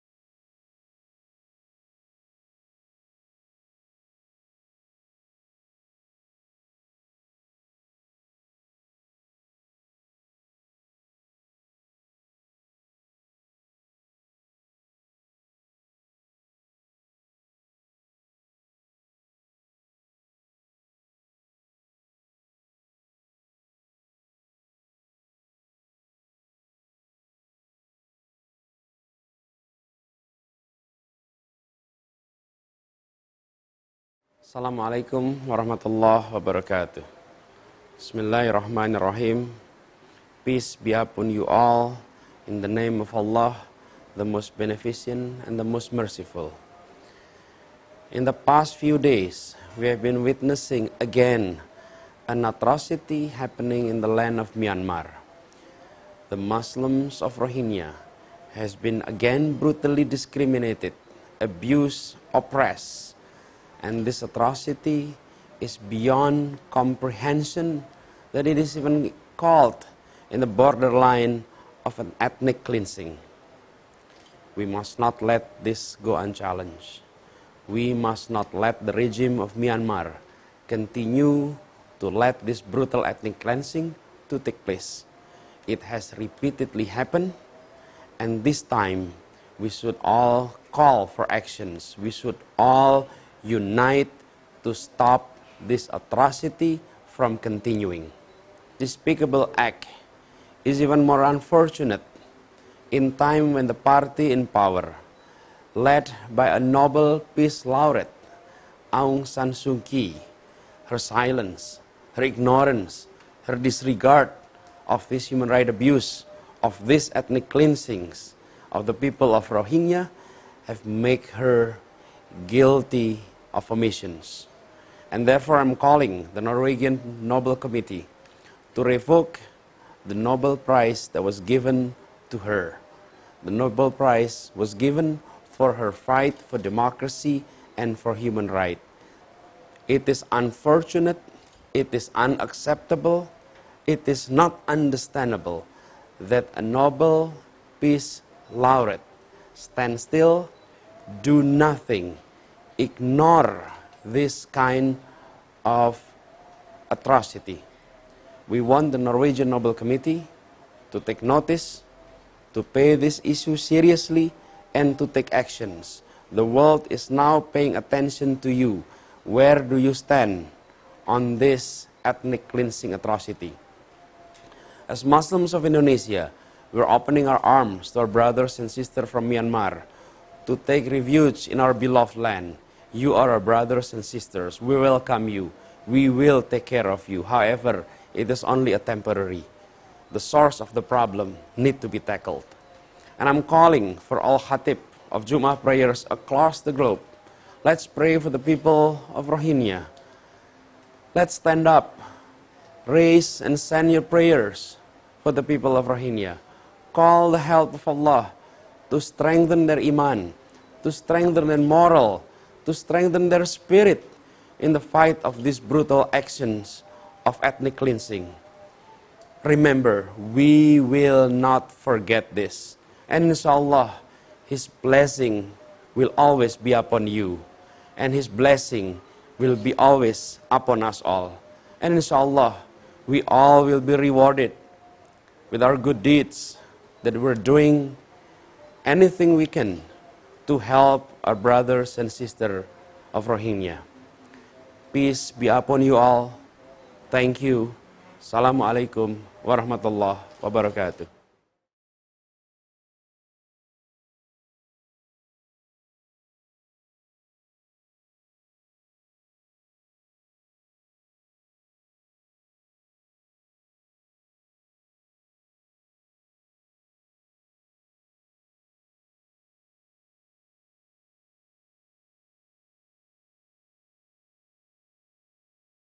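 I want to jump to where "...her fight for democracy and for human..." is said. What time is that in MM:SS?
02:15.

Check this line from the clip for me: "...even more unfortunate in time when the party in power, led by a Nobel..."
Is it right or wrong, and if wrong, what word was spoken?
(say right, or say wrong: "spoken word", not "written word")
right.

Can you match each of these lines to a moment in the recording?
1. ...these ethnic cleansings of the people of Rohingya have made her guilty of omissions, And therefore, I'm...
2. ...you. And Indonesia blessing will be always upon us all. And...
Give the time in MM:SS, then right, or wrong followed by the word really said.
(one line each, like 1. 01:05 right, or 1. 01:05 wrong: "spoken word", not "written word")
1. 01:56 right
2. 03:47 wrong: "His", not "Indonesia".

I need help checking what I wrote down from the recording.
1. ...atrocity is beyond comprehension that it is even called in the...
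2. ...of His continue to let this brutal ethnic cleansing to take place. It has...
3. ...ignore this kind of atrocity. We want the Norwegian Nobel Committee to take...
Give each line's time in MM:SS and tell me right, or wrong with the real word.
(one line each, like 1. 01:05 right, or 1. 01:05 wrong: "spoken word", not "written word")
1. 01:04 right
2. 01:19 wrong: "Myanmar", not "His"
3. 02:32 right.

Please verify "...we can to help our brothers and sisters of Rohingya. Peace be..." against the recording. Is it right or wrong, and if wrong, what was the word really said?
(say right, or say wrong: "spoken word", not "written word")
right.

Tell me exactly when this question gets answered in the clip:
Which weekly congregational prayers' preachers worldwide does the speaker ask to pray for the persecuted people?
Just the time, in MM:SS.
03:15.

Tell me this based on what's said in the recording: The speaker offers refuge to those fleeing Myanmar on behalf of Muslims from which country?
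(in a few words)
Indonesia.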